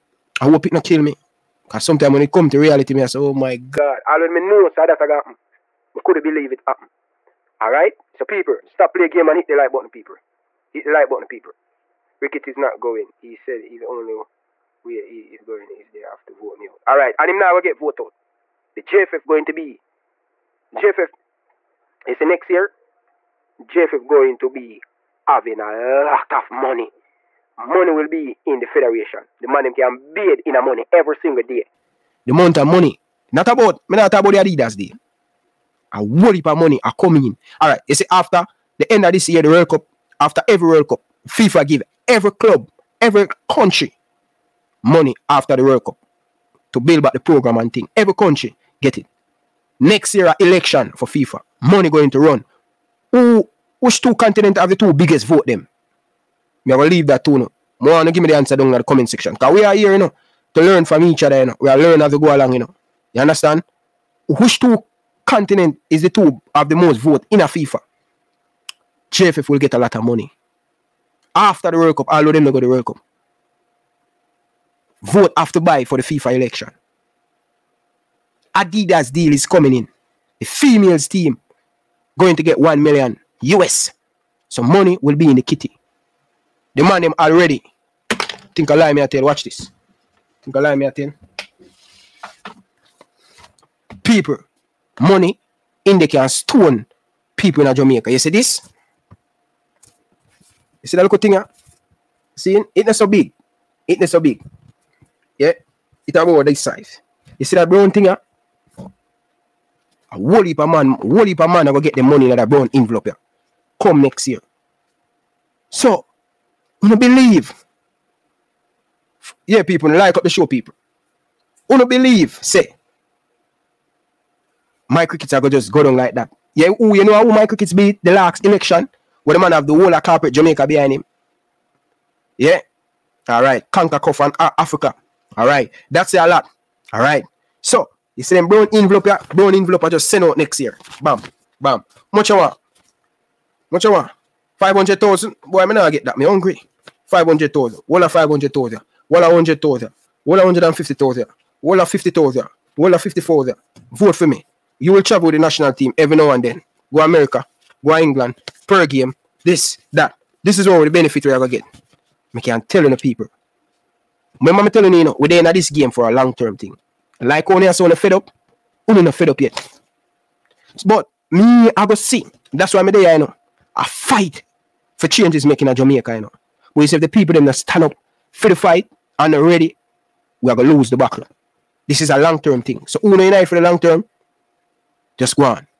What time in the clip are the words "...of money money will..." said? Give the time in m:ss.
0:26.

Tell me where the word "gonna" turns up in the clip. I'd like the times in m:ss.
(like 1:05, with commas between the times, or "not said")
2:05, 3:00.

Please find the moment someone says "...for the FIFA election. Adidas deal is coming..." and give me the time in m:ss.
1:15.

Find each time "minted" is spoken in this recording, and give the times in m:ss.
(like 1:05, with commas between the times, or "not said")
not said.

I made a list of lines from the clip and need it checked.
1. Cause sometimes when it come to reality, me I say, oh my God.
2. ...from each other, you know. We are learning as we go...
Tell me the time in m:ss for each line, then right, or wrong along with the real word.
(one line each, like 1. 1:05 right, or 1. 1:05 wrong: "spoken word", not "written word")
1. 0:01 right
2. 1:00 right.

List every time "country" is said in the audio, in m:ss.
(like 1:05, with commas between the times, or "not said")
0:43, 0:48.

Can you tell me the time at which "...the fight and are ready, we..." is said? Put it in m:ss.
2:58.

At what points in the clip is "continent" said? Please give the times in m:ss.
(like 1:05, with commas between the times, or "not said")
0:54, 1:05.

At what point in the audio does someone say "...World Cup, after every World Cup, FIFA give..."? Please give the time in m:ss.
0:39.